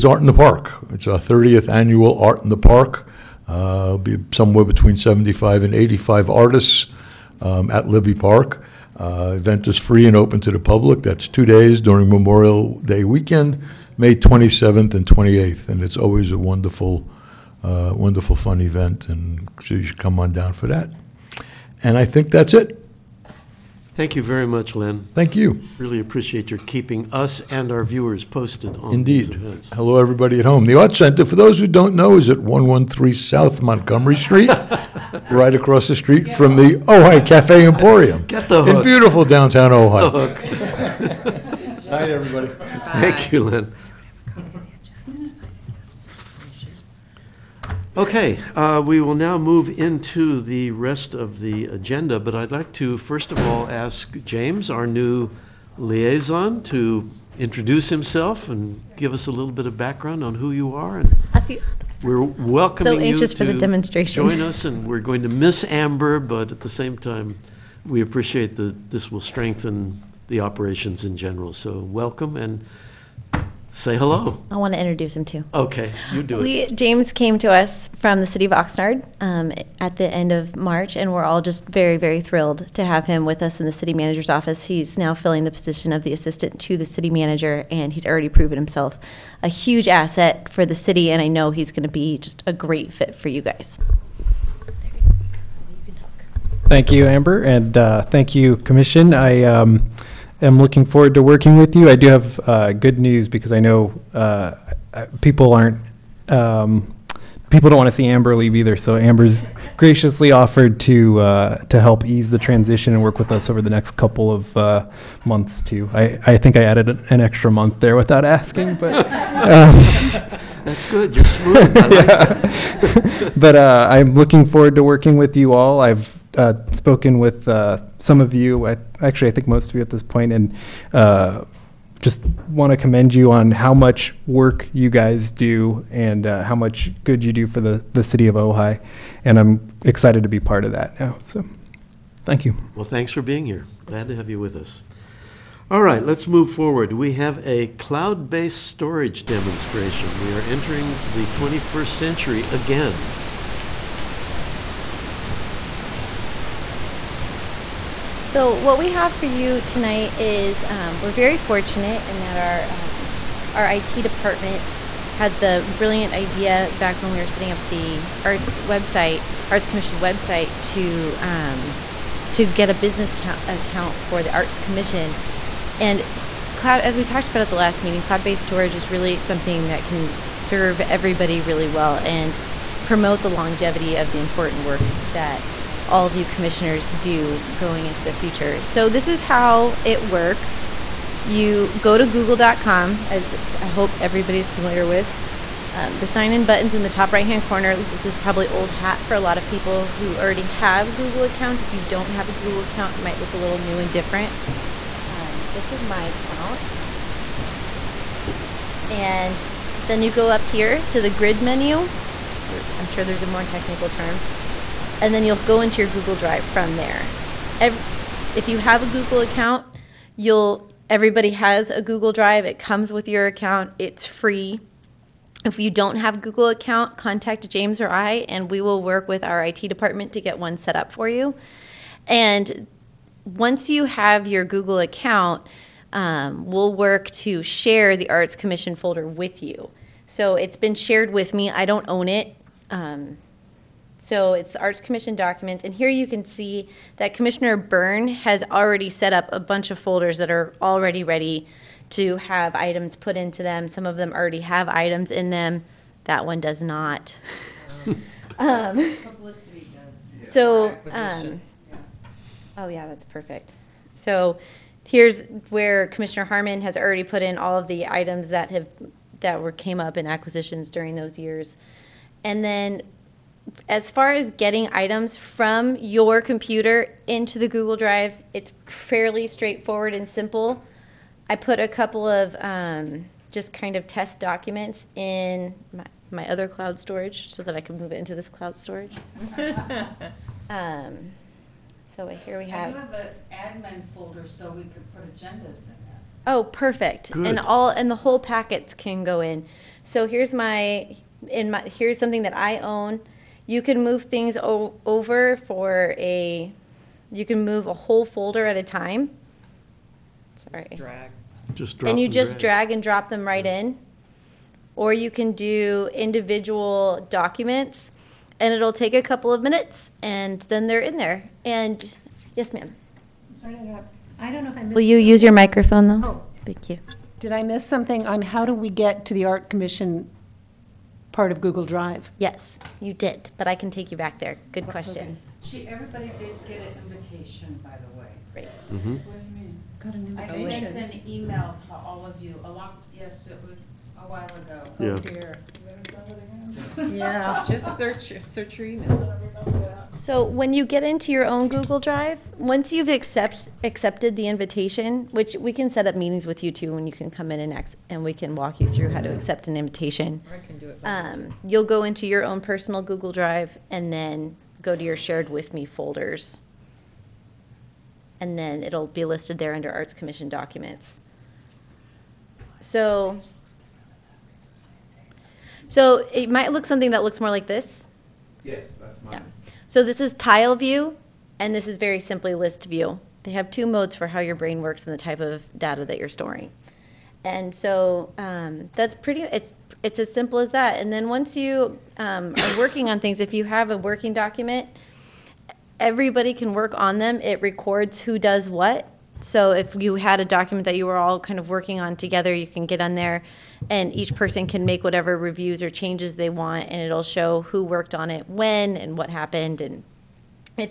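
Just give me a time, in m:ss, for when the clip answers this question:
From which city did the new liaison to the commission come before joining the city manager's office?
1:18.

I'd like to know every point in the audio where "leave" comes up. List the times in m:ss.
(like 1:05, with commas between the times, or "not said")
1:48.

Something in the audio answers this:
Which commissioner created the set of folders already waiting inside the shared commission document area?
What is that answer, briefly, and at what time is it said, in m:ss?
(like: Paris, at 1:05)
Commissioner Byrne, at 4:07.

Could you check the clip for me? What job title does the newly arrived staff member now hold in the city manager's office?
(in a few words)
Assistant to the city manager.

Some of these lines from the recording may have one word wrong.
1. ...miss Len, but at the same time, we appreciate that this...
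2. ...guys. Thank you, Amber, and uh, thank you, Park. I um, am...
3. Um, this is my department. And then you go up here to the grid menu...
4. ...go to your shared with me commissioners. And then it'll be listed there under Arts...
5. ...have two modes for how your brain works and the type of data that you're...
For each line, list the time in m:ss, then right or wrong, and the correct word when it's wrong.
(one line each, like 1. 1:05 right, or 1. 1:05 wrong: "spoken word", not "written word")
1. 1:05 wrong: "Amber", not "Len"
2. 1:33 wrong: "Commission", not "Park"
3. 3:25 wrong: "account", not "department"
4. 6:04 wrong: "folders", not "commissioners"
5. 6:23 right.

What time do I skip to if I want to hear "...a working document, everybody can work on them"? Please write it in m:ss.
6:33.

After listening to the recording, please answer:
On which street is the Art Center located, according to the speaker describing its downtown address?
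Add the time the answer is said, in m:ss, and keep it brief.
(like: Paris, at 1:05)
South Montgomery Street, at 0:33.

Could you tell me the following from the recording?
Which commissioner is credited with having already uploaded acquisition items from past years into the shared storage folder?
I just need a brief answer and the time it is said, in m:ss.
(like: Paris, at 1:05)
Commissioner Harmon, at 4:25.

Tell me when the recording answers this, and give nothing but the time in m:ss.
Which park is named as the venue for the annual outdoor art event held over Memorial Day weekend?
0:07.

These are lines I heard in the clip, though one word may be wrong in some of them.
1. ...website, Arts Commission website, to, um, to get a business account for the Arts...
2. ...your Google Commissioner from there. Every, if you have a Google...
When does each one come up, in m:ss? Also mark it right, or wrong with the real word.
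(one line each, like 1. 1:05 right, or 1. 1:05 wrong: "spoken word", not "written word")
1. 2:48 right
2. 3:35 wrong: "Drive", not "Commissioner".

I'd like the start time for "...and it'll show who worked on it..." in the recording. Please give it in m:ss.
6:46.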